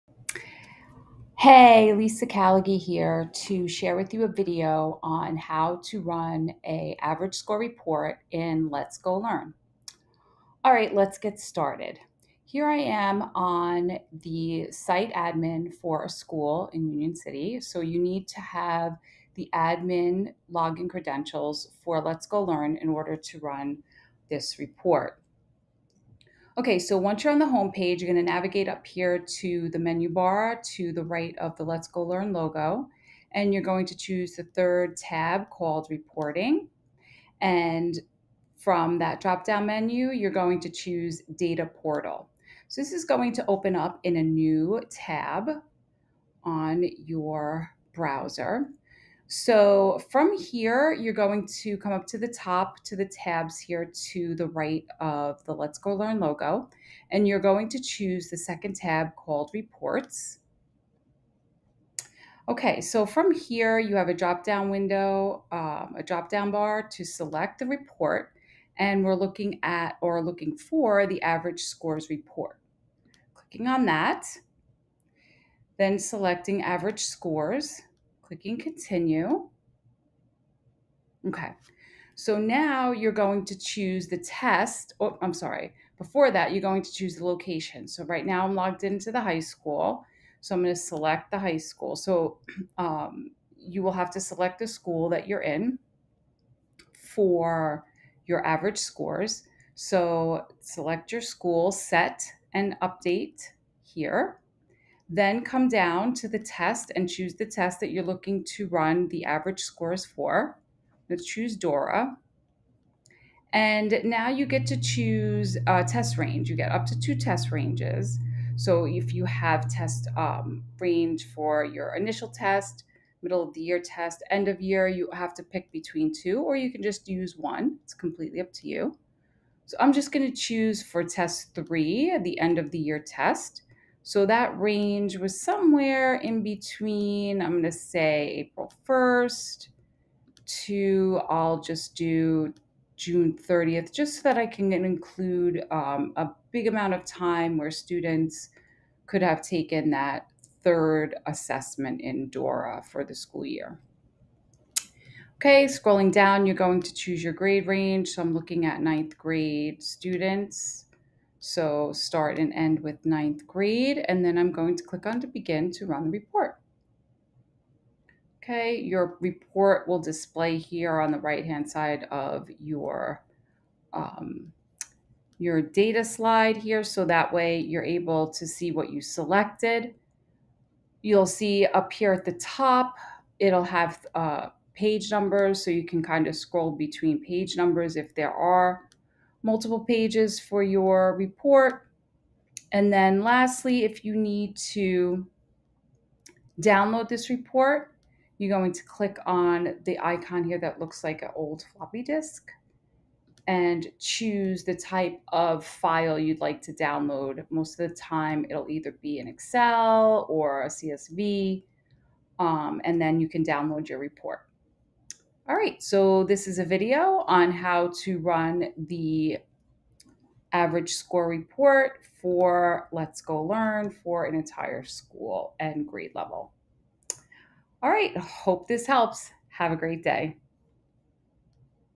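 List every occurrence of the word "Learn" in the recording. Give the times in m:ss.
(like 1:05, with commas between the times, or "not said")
0:09, 0:22, 0:32, 0:55, 3:43.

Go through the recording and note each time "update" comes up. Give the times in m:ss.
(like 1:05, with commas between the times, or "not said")
1:42.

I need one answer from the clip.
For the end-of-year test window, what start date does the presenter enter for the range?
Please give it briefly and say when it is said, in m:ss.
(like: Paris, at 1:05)
April 1st, at 2:18.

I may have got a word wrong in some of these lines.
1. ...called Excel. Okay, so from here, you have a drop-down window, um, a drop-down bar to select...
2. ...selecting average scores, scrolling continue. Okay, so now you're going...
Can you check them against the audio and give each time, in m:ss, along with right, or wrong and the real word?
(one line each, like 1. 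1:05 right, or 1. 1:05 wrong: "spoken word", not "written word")
1. 0:59 wrong: "Reports", not "Excel"
2. 1:15 wrong: "clicking", not "scrolling".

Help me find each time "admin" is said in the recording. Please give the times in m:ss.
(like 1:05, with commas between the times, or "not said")
0:15, 0:19.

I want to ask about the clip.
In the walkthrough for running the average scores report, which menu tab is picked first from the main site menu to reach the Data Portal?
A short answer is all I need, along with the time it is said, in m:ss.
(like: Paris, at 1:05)
Reporting, at 0:35.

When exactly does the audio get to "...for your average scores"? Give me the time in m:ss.
1:36.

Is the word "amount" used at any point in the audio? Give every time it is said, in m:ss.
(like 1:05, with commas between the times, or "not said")
2:26.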